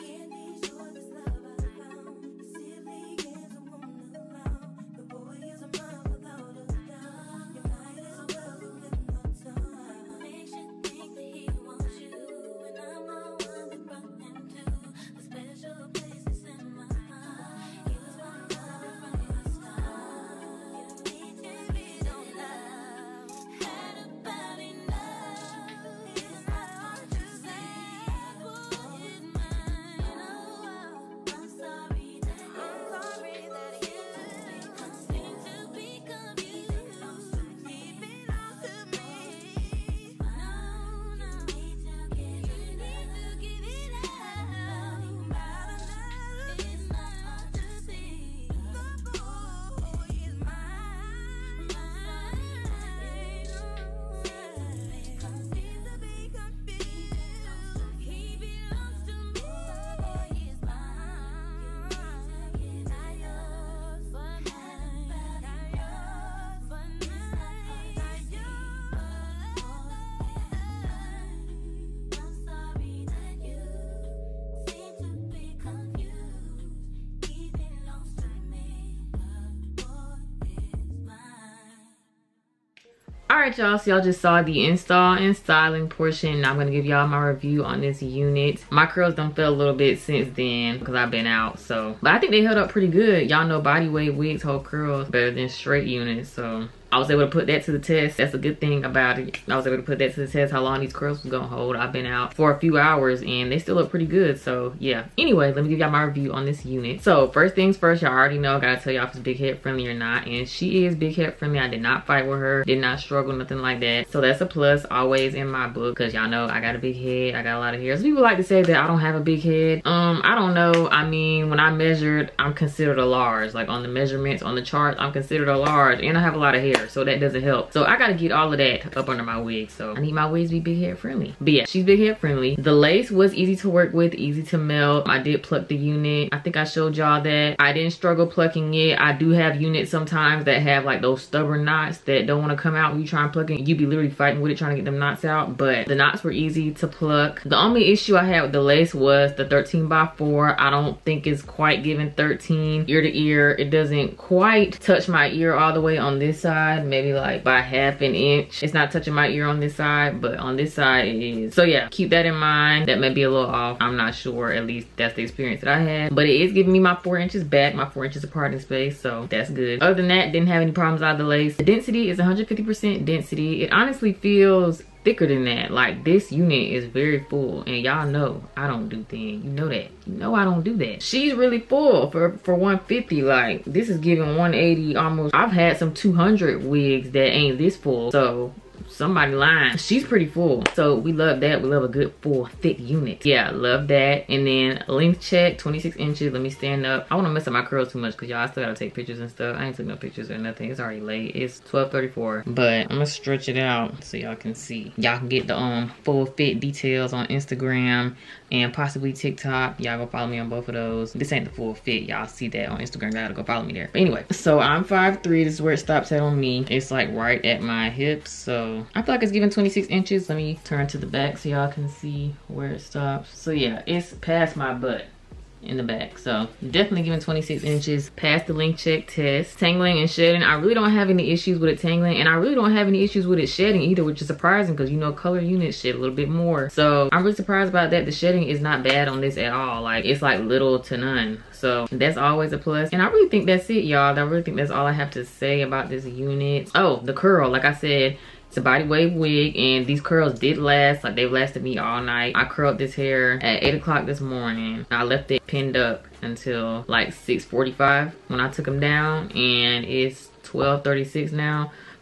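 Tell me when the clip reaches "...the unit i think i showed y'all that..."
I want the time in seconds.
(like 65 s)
135 s.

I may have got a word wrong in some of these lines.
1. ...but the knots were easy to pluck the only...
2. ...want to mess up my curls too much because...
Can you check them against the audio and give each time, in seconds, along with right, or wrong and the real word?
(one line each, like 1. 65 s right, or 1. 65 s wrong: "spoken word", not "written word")
1. 145 s right
2. 197 s right.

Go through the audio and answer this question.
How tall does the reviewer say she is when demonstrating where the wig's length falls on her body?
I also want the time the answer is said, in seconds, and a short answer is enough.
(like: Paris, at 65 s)
5'3", at 214 s.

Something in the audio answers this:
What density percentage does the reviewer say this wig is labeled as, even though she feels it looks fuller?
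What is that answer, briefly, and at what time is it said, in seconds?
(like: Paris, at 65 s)
150%, at 172 s.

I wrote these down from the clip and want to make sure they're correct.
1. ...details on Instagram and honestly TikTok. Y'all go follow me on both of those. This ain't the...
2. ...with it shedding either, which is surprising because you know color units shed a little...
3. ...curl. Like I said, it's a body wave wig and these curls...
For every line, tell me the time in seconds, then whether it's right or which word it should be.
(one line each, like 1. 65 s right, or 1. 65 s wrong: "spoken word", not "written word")
1. 206 s wrong: "possibly", not "honestly"
2. 233 s right
3. 247 s right.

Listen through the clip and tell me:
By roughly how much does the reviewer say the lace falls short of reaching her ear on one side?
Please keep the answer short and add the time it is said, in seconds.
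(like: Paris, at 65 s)
half an inch, at 157 s.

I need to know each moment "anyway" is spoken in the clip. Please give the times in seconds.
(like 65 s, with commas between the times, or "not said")
105 s, 214 s.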